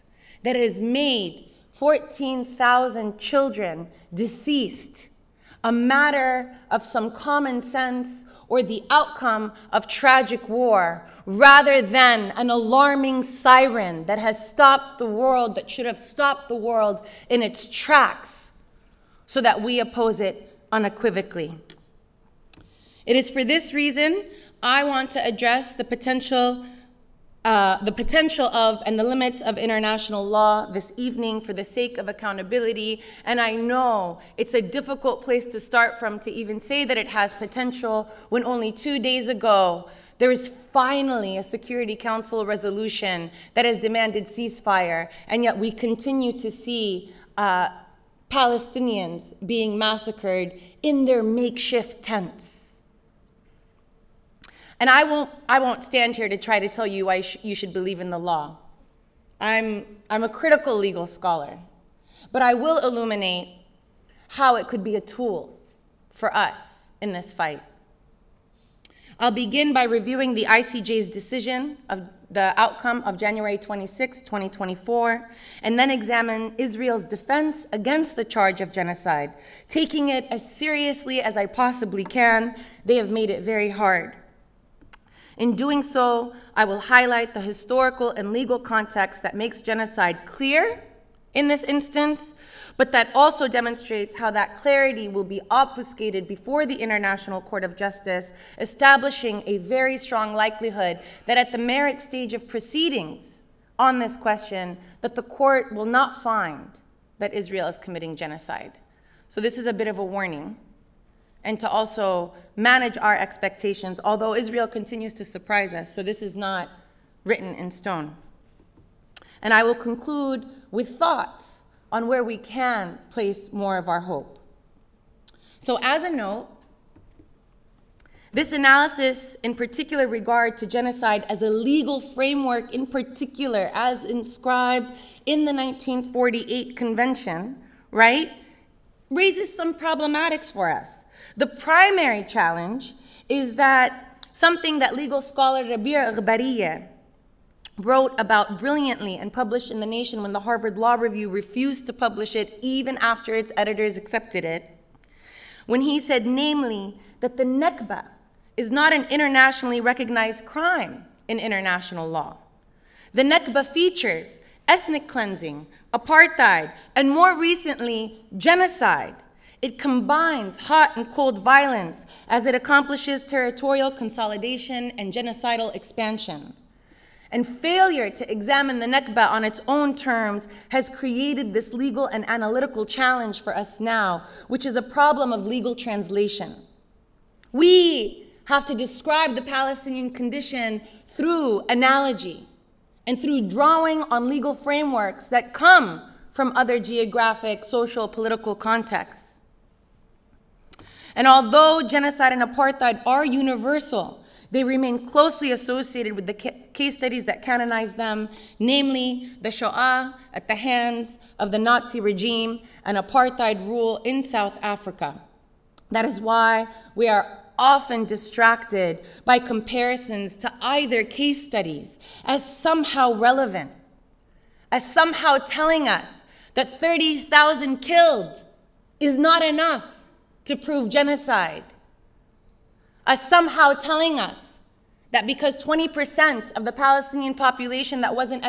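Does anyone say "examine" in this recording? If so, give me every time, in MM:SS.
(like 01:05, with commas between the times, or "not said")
01:15, 02:58.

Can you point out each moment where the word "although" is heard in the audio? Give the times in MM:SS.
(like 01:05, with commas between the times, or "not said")
01:54, 03:21.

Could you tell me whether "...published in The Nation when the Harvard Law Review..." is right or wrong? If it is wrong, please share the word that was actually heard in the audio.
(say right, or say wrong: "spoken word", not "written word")
right.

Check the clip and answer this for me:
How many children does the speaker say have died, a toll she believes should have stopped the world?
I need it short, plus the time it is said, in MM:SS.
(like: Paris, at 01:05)
14,000, at 00:01.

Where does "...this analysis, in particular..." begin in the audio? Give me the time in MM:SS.
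02:08.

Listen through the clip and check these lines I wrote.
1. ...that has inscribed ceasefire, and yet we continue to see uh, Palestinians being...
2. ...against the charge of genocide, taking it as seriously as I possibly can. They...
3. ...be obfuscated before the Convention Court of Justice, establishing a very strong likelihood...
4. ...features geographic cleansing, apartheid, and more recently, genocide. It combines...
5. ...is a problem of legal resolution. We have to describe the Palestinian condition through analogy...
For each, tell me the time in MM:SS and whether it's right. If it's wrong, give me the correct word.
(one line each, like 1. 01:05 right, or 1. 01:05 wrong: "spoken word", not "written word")
1. 00:43 wrong: "demanded", not "inscribed"
2. 01:17 right
3. 01:35 wrong: "International", not "Convention"
4. 02:43 wrong: "ethnic", not "geographic"
5. 03:04 wrong: "translation", not "resolution".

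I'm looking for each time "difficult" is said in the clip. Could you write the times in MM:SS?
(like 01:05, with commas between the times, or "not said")
00:34.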